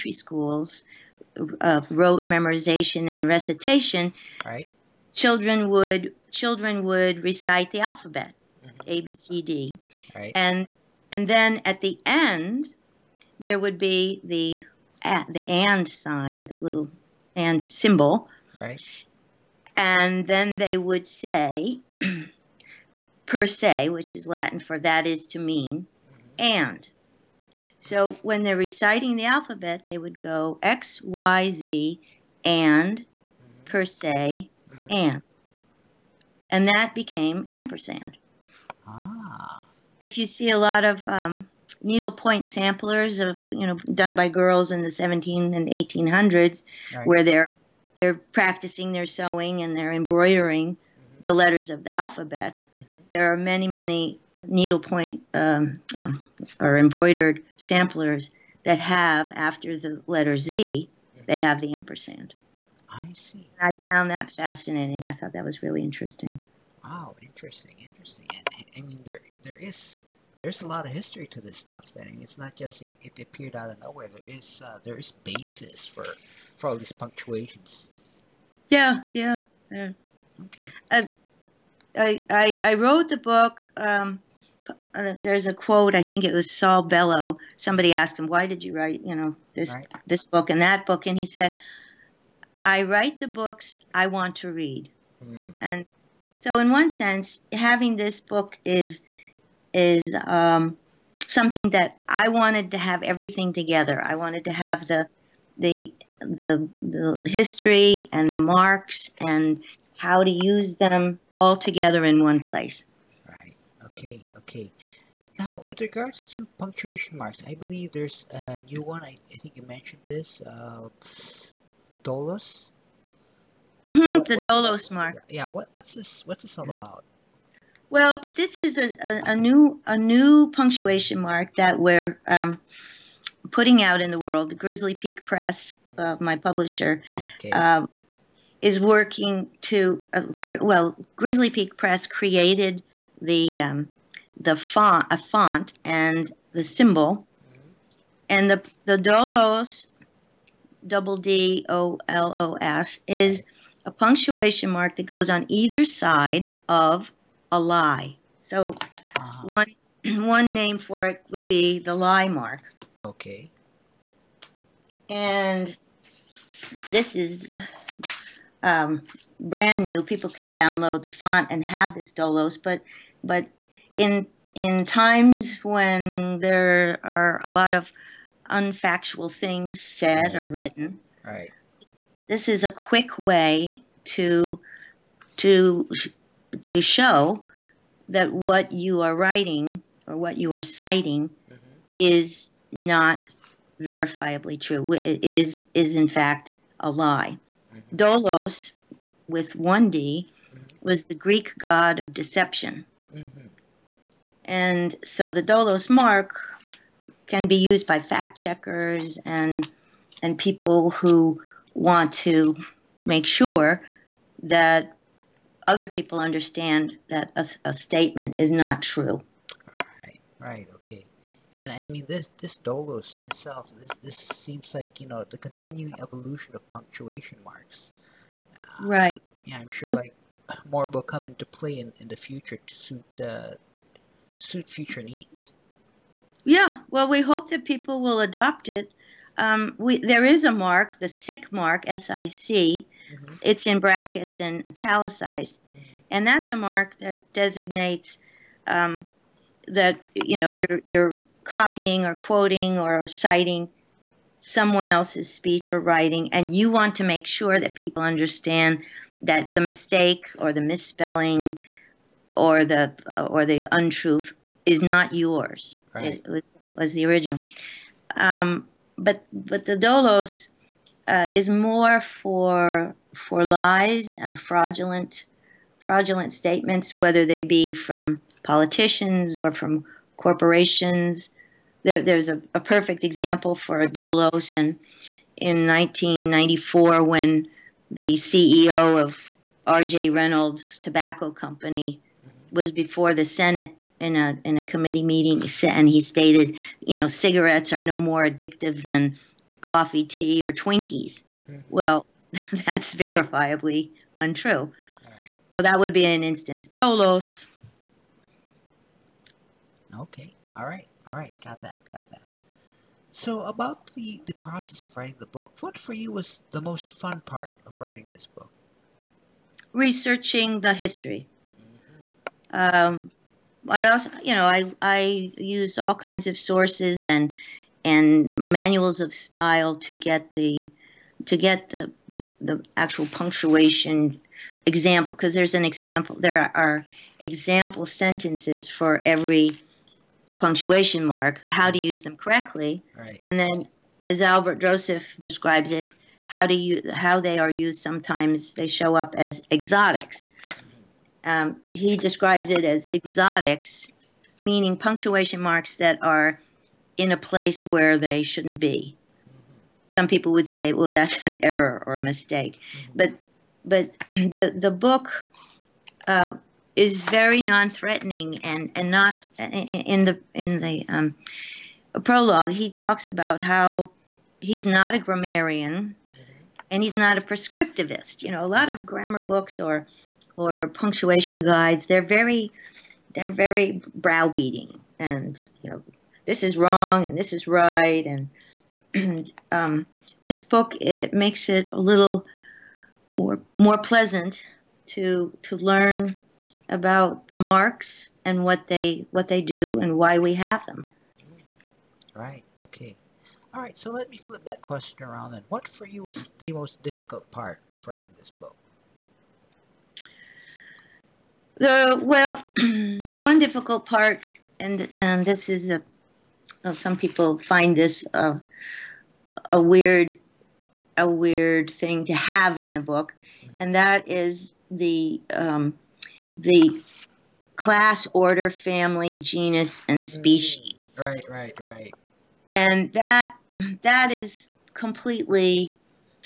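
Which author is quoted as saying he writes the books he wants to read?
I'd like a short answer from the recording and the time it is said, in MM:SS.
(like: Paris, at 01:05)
Saul Bellow, at 01:26.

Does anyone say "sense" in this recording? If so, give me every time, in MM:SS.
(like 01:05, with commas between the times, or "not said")
01:36.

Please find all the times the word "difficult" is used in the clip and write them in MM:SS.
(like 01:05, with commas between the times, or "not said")
06:46, 06:53.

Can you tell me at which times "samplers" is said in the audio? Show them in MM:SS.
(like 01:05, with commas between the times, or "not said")
00:42, 00:57.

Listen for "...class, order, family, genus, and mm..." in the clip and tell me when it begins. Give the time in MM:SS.
07:07.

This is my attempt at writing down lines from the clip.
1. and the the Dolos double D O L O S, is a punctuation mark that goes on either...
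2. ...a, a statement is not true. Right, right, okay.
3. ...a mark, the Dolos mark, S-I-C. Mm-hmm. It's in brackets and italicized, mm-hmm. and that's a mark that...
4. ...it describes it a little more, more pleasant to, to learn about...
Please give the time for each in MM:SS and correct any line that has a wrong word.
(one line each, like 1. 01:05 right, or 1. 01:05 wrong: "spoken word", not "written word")
1. 02:28 right
2. 03:37 right
3. 04:00 wrong: "SIC", not "Dolos"
4. 06:30 wrong: "makes", not "describes".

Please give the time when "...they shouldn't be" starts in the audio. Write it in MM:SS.
05:57.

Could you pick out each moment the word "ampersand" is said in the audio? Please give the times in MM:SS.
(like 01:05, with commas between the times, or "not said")
00:37, 01:01.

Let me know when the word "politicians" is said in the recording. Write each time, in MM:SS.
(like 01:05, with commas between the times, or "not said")
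04:38.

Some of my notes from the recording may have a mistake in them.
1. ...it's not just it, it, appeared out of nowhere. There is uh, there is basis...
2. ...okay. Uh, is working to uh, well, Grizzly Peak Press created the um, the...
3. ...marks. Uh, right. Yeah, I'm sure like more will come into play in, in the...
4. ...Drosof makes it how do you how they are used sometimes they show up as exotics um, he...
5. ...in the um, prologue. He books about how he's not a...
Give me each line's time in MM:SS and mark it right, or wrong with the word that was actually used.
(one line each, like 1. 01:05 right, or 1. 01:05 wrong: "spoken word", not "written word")
1. 01:12 right
2. 02:17 right
3. 03:47 right
4. 05:44 wrong: "describes", not "makes"
5. 06:10 wrong: "talks", not "books".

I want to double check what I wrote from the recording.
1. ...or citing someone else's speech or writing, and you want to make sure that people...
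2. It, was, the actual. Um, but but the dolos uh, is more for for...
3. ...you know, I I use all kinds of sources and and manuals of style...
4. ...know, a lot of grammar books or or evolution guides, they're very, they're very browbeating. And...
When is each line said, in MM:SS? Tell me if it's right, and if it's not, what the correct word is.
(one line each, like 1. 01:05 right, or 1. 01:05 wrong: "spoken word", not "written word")
1. 04:12 right
2. 04:26 wrong: "original", not "actual"
3. 05:24 right
4. 06:18 wrong: "punctuation", not "evolution".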